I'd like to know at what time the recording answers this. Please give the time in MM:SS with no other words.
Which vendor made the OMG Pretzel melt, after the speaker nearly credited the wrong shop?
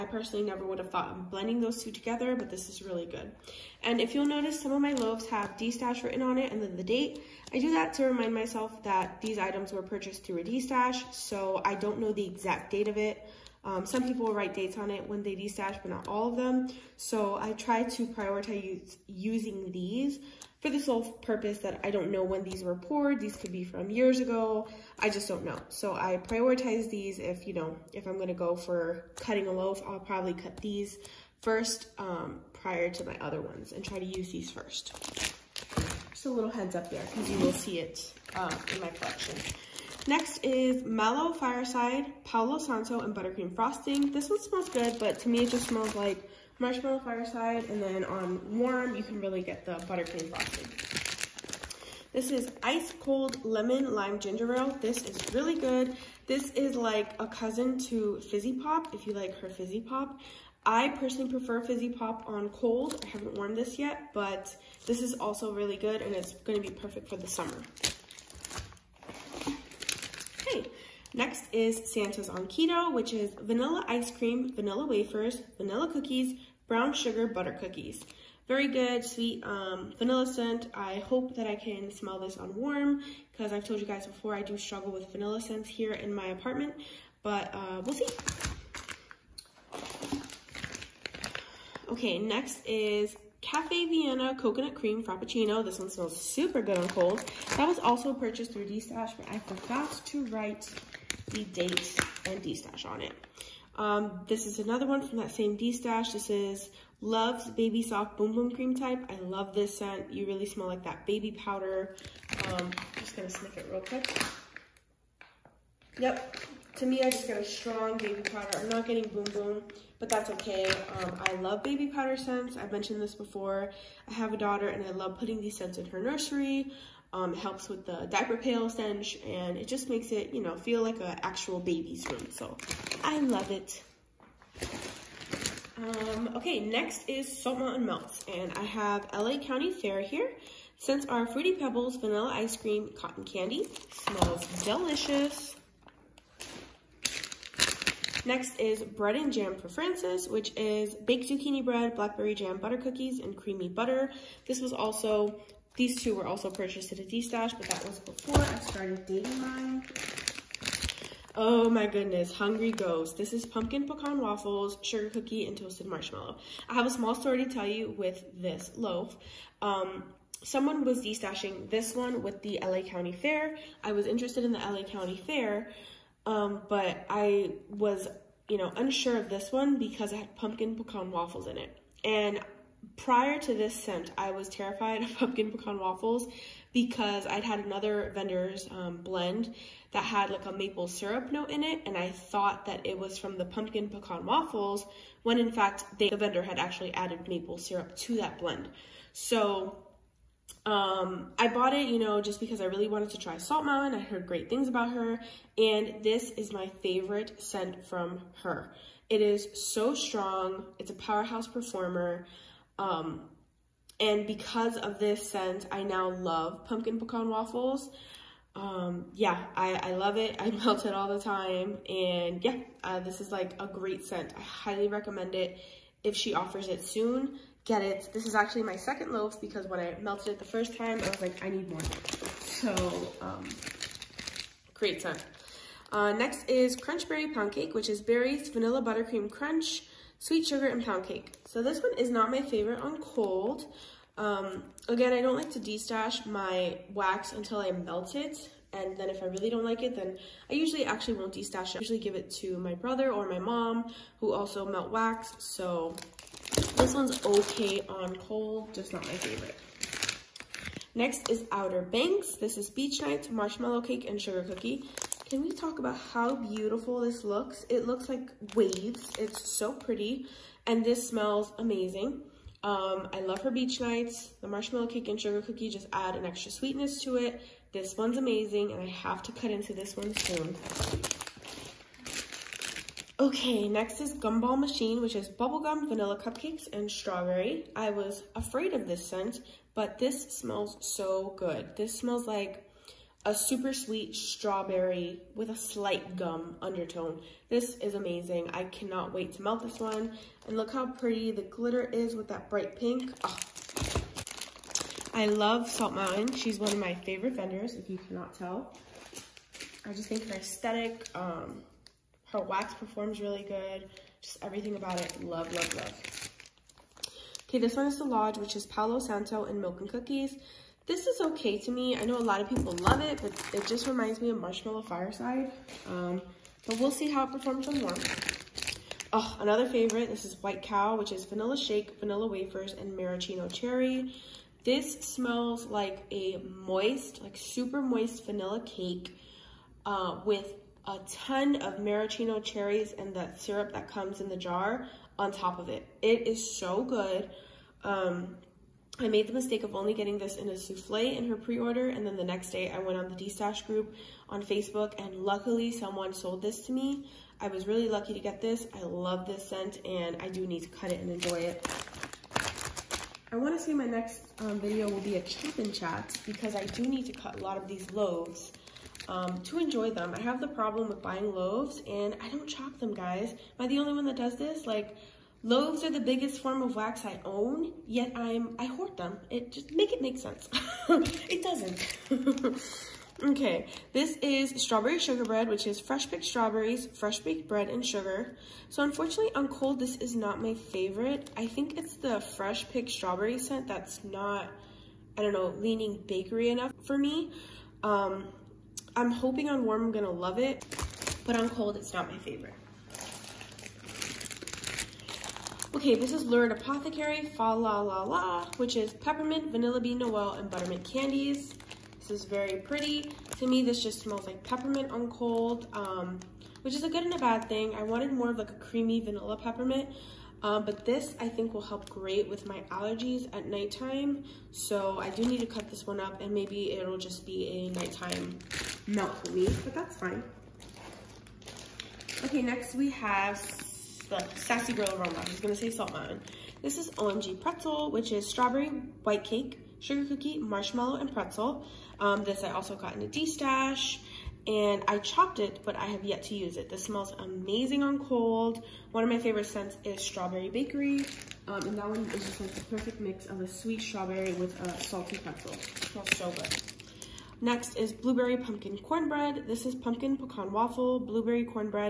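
07:14.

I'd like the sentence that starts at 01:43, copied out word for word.
Um, this is another one from that same D stash.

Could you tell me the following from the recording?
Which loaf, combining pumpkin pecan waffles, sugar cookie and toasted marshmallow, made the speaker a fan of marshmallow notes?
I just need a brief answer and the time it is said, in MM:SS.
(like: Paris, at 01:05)
Hungry Ghost, at 02:42.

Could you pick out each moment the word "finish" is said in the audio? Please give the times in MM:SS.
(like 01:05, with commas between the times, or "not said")
not said.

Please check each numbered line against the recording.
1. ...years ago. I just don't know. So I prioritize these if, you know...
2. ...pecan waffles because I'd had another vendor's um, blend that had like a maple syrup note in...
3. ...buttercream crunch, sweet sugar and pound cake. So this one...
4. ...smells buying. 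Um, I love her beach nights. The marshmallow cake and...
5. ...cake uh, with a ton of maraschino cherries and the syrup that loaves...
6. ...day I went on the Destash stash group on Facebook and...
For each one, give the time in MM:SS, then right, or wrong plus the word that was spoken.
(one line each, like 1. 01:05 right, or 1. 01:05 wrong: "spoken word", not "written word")
1. 00:23 right
2. 03:05 right
3. 03:58 right
4. 04:31 wrong: "amazing", not "buying"
5. 05:38 wrong: "comes", not "loaves"
6. 05:52 right.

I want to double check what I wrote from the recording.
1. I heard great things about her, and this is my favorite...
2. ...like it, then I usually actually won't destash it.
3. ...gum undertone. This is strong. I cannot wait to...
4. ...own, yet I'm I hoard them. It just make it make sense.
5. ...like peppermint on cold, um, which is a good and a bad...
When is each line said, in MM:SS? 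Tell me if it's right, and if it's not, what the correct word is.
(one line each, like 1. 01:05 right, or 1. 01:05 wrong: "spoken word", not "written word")
1. 03:23 right
2. 04:09 right
3. 04:56 wrong: "amazing", not "strong"
4. 06:17 right
5. 06:54 right.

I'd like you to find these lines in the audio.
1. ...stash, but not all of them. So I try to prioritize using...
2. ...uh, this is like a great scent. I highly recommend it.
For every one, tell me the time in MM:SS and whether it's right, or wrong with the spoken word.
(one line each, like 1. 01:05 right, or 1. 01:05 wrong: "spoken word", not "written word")
1. 00:15 right
2. 03:42 right.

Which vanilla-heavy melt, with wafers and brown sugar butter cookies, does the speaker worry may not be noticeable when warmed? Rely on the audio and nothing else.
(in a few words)
Santa's on Keto.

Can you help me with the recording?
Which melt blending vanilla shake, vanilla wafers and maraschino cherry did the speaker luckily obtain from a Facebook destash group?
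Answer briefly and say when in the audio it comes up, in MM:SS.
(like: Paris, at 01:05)
White Cow, at 05:30.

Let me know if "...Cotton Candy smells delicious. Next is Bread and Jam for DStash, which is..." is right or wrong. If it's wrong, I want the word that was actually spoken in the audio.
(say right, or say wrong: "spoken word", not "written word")
wrong: "Francis", not "DStash".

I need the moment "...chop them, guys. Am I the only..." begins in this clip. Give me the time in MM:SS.
06:12.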